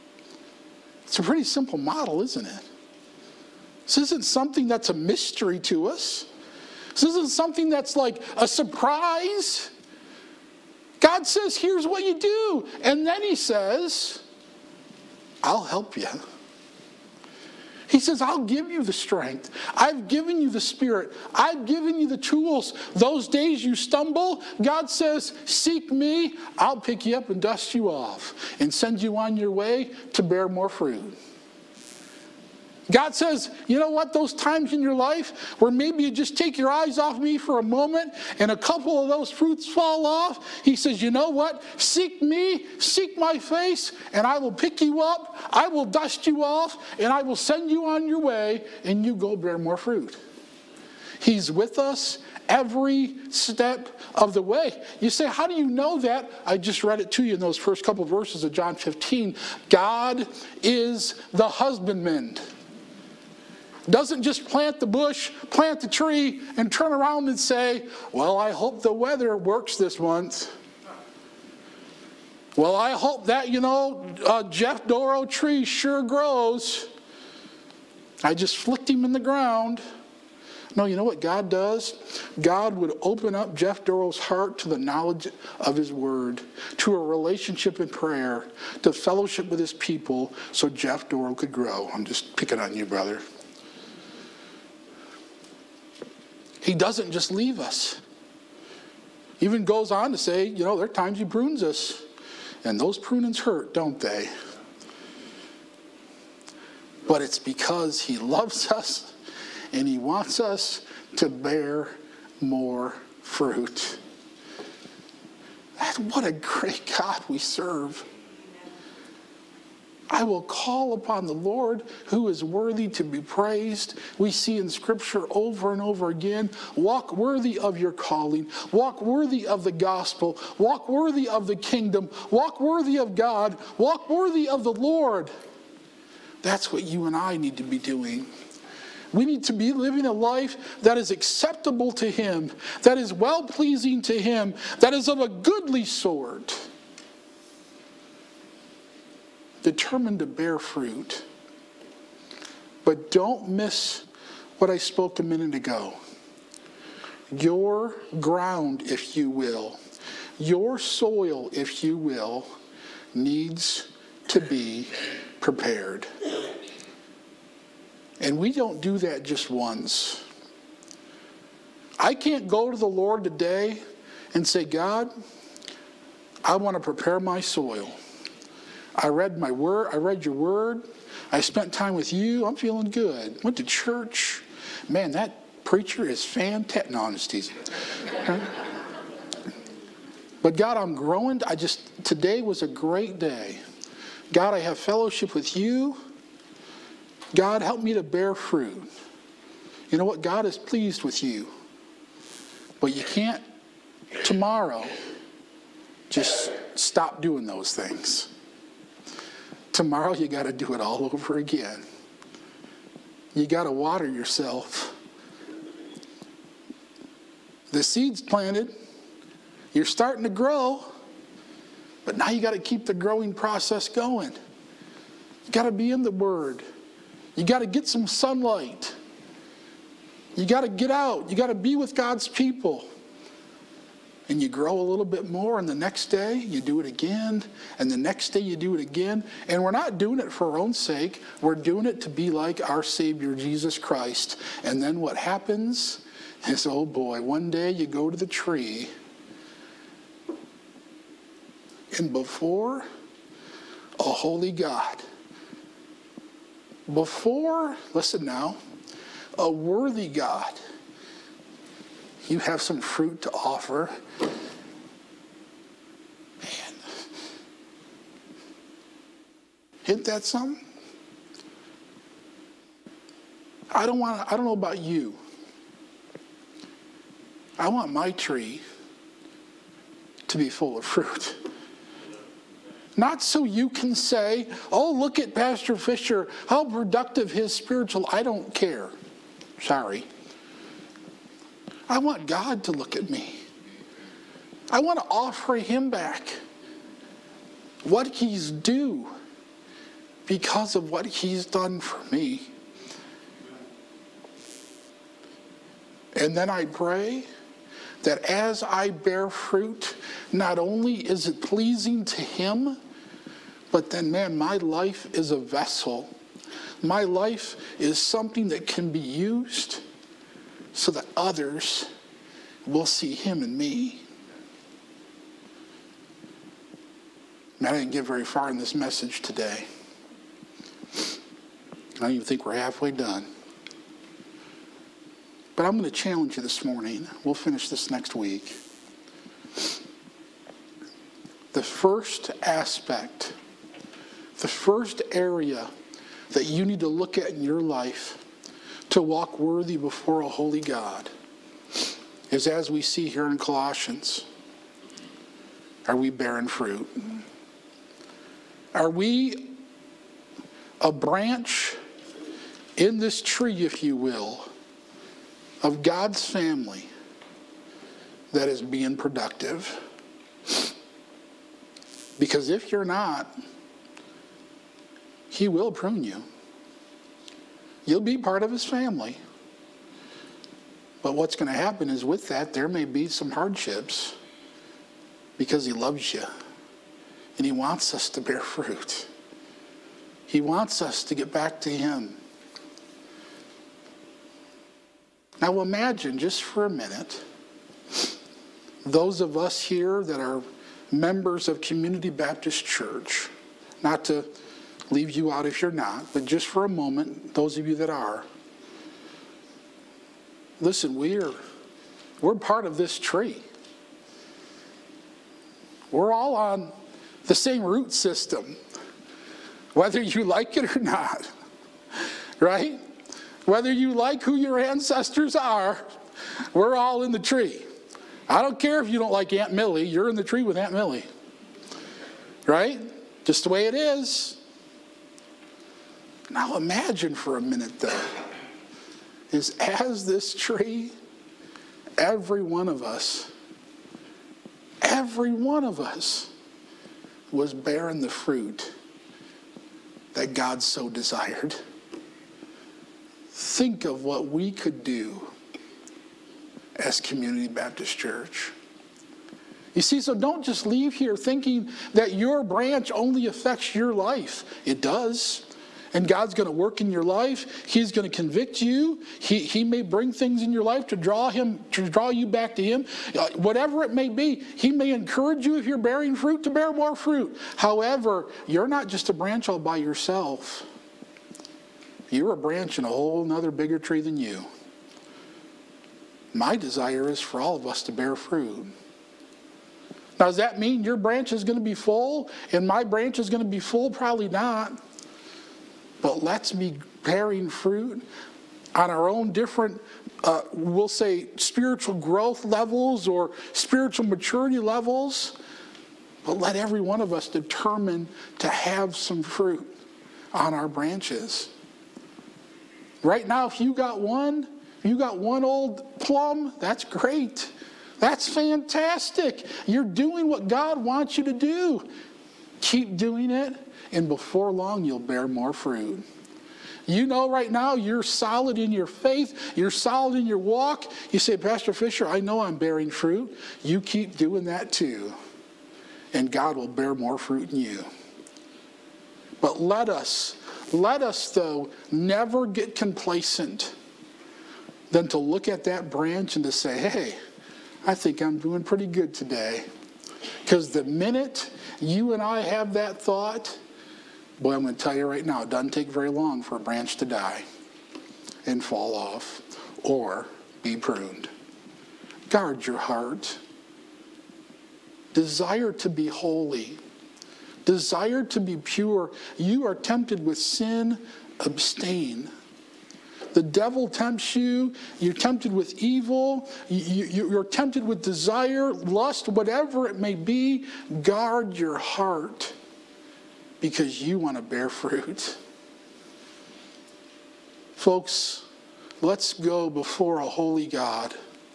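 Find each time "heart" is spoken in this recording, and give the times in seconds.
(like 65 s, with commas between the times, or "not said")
84 s, 562 s, 581 s.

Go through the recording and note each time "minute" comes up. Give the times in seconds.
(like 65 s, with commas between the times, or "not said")
155 s, 396 s, 437 s, 550 s.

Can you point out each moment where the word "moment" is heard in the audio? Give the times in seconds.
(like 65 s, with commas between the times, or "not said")
37 s, 406 s.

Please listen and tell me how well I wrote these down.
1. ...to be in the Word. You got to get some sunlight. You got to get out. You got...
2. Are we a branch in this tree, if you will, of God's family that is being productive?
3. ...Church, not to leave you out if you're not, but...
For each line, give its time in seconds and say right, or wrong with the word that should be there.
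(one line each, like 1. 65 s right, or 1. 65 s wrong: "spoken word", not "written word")
1. 225 s right
2. 358 s right
3. 402 s right.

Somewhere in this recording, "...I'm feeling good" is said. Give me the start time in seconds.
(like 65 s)
182 s.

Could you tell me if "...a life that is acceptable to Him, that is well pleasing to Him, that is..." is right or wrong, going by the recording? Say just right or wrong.
right.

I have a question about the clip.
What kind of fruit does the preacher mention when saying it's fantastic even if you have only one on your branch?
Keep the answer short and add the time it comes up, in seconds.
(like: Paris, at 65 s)
Plum, at 516 s.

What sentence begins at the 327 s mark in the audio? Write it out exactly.
And I didn't get very far in this message today.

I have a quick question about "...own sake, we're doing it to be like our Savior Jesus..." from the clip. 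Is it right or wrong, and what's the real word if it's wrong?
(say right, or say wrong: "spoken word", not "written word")
right.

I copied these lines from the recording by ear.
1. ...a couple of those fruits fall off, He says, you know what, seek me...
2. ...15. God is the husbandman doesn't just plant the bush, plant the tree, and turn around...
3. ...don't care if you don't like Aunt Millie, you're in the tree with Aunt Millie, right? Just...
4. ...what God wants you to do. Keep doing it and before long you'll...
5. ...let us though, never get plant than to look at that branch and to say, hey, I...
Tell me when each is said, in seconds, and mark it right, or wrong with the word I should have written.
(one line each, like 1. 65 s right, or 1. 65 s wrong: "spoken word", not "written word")
1. 38 s right
2. 58 s right
3. 428 s right
4. 520 s right
5. 540 s wrong: "complacent", not "plant".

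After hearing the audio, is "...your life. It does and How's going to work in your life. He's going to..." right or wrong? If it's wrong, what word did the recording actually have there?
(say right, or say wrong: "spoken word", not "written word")
wrong: "God", not "How".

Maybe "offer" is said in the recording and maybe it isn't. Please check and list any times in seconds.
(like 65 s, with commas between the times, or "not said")
263 s, 295 s.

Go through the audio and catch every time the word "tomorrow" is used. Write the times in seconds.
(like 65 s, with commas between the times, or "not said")
204 s, 209 s.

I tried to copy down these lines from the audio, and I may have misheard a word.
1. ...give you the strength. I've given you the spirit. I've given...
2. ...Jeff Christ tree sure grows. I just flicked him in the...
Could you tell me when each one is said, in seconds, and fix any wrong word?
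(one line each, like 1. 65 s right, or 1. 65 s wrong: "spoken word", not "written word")
1. 18 s right
2. 74 s wrong: "Doro", not "Christ".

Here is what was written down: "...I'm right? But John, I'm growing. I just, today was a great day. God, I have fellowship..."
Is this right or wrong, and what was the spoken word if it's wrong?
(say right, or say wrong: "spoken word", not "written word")
wrong: "God", not "John".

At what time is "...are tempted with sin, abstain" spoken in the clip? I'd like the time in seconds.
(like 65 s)
569 s.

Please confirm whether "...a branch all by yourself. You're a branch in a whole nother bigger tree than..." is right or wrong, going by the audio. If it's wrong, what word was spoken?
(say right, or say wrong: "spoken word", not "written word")
right.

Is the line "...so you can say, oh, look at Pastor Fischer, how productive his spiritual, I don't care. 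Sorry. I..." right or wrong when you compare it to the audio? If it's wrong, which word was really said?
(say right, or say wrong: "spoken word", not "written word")
right.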